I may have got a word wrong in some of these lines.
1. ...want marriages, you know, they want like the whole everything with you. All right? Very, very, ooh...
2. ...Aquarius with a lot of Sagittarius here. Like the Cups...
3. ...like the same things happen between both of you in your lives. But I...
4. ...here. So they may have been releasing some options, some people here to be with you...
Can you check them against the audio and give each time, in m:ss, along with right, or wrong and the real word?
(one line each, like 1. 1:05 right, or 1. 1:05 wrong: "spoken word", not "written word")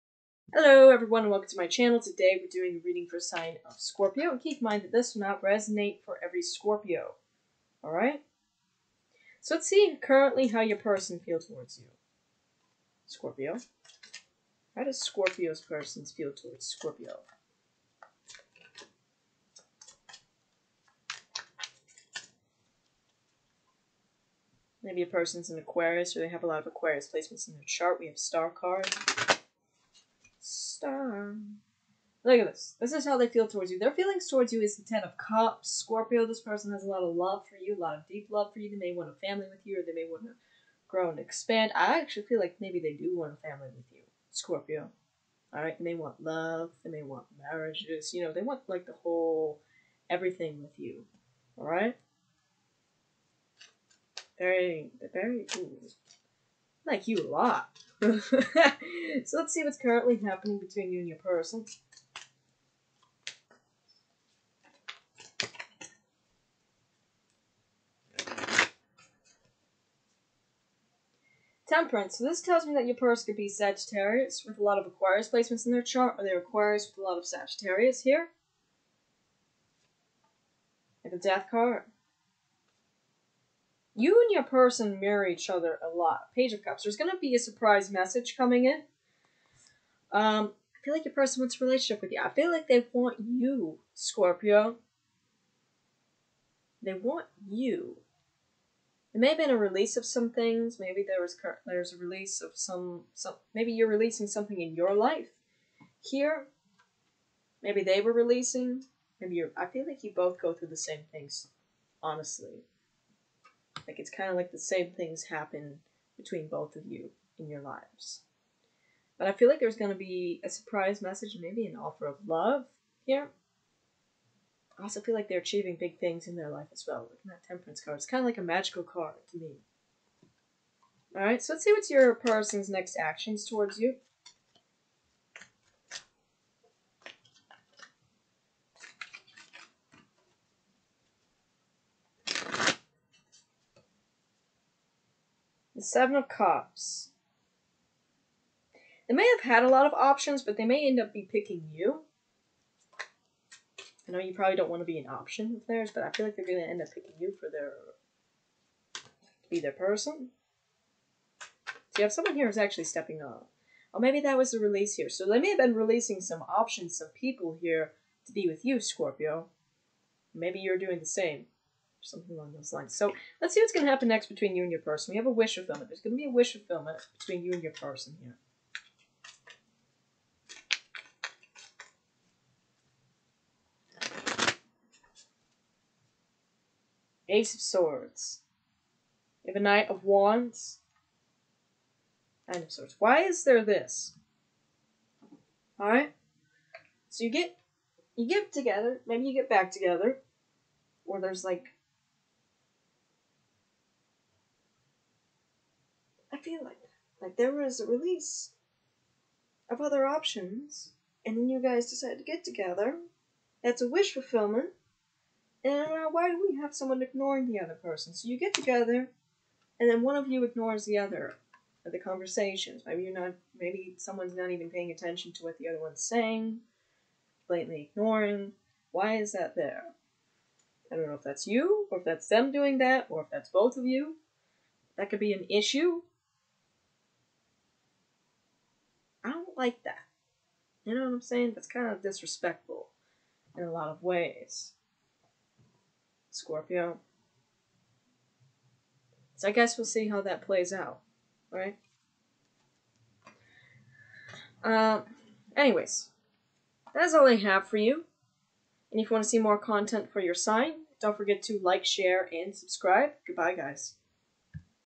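1. 0:47 right
2. 1:16 wrong: "Death", not "Cups"
3. 1:54 right
4. 2:44 right.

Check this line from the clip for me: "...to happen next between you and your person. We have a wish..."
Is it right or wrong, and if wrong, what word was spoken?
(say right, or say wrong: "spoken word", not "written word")
right.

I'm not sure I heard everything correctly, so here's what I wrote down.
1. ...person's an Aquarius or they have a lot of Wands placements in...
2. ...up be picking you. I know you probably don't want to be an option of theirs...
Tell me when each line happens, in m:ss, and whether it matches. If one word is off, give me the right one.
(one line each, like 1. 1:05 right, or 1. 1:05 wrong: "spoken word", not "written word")
1. 0:25 wrong: "Aquarius", not "Wands"
2. 2:30 right.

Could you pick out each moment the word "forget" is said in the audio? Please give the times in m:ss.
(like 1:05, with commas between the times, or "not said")
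4:21.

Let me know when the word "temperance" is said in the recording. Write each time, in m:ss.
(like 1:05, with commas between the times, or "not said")
1:11, 2:07.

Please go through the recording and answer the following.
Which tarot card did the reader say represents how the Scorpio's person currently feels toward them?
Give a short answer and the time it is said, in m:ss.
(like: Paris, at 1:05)
Ten of Cups, at 0:34.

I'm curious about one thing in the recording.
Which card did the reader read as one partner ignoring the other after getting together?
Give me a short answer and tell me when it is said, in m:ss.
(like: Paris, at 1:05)
Nine of Swords, at 3:12.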